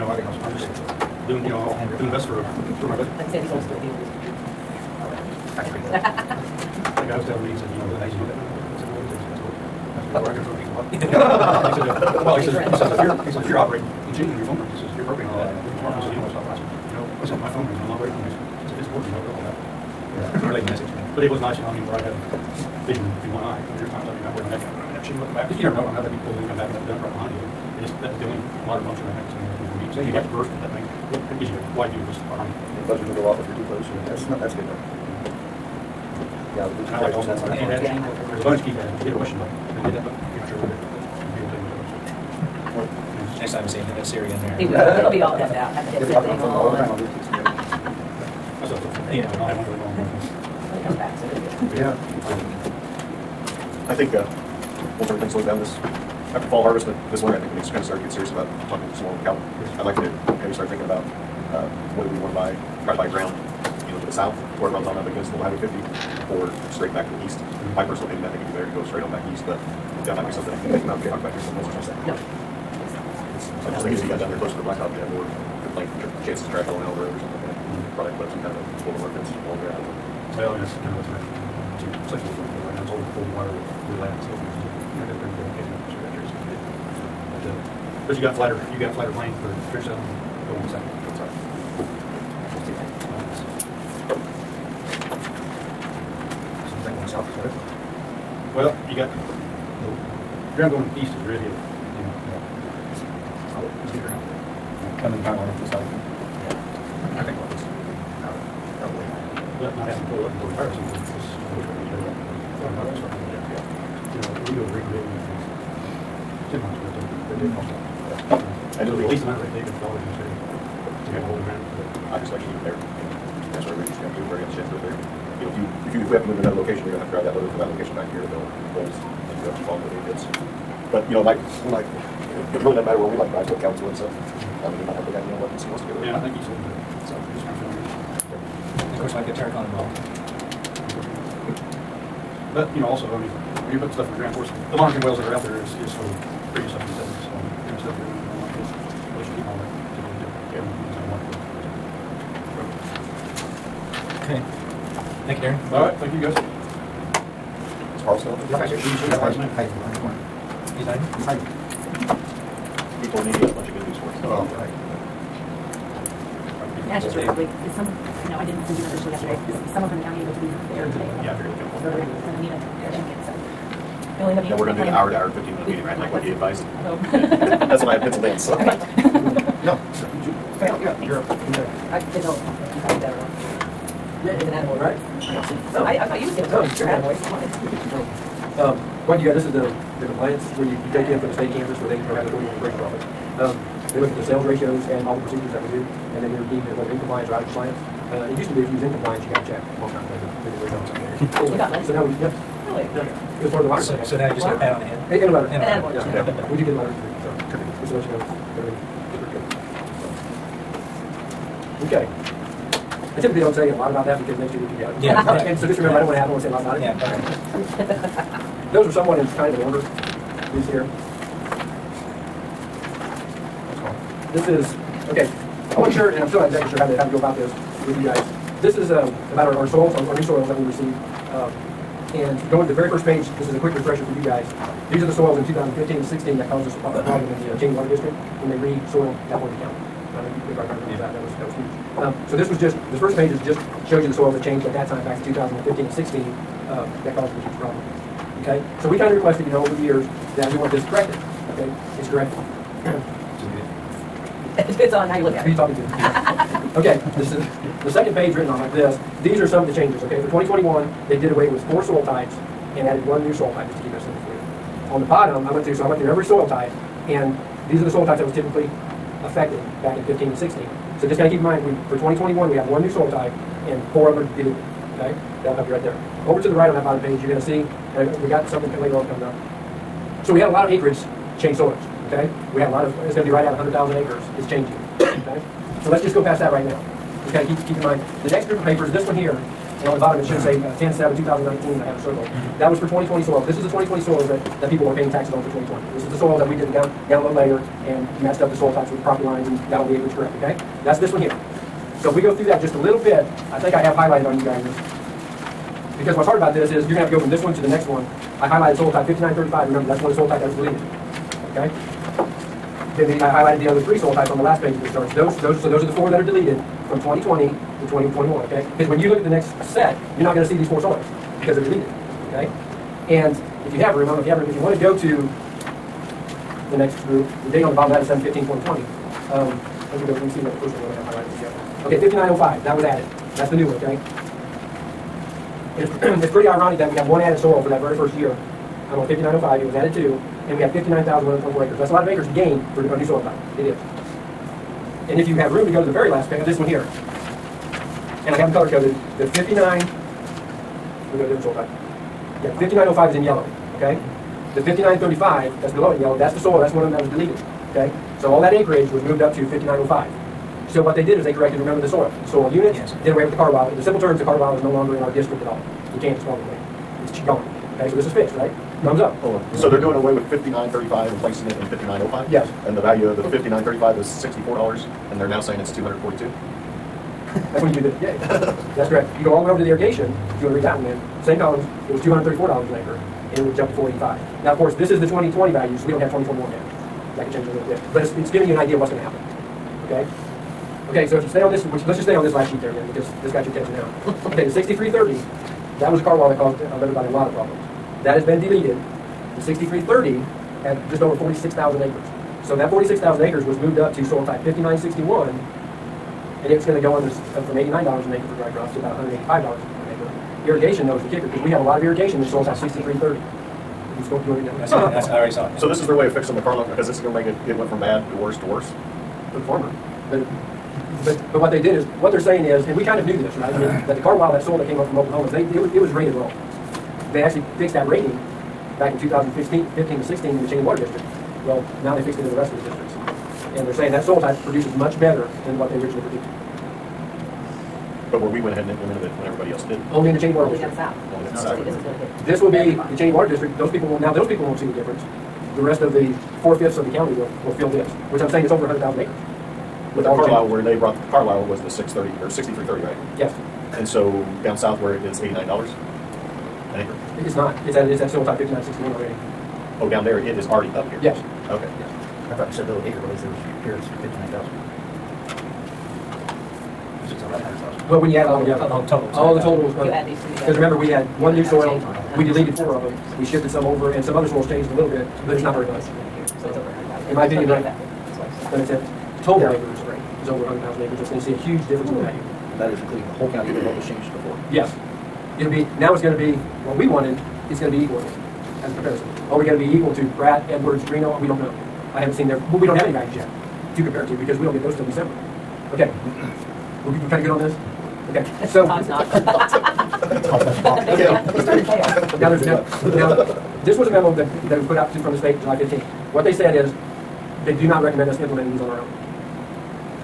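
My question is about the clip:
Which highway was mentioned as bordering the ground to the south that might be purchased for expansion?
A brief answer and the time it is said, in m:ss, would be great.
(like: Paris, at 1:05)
Highway 50, at 1:05.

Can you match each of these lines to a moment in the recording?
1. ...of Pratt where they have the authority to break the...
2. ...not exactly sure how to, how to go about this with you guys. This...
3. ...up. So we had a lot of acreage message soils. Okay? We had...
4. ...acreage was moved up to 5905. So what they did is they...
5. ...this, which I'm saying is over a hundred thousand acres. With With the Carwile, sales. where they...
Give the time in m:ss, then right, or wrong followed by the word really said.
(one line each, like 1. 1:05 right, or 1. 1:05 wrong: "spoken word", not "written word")
1. 3:11 wrong: "Kansas", not "Pratt"
2. 3:46 right
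3. 4:39 wrong: "change", not "message"
4. 5:58 right
5. 7:27 wrong: "changes", not "sales".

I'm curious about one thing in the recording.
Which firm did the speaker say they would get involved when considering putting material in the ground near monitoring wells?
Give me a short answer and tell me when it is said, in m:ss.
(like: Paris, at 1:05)
Terracon, at 2:19.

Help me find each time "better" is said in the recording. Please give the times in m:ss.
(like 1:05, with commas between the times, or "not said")
1:08, 7:15.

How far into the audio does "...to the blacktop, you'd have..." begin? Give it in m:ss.
1:14.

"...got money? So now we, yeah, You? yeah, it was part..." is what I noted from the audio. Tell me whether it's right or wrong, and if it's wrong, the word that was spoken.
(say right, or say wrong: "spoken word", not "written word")
wrong: "Really", not "You".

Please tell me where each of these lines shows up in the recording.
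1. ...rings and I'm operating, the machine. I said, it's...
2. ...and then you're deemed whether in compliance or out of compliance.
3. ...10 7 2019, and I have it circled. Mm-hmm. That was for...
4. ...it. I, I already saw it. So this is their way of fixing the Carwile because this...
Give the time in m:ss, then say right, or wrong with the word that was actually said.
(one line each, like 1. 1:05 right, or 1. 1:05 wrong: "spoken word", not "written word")
1. 0:17 right
2. 3:15 right
3. 4:50 right
4. 6:54 right.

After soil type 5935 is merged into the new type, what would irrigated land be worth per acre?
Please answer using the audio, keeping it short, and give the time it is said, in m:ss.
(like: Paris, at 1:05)
$485, at 6:23.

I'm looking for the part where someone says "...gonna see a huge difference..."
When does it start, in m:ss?
8:01.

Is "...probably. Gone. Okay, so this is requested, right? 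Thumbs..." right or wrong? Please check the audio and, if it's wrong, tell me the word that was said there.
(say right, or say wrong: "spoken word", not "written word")
wrong: "fixed", not "requested".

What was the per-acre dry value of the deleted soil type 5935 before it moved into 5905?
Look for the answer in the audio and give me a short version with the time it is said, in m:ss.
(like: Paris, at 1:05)
$64, at 6:14.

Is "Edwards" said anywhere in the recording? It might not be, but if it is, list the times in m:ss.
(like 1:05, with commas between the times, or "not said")
8:10.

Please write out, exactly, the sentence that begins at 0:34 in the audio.
That's not, that's a good thing.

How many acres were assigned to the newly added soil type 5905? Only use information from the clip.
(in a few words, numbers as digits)
59,124.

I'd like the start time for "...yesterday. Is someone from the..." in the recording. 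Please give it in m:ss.
2:49.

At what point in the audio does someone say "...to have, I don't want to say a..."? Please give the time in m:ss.
3:36.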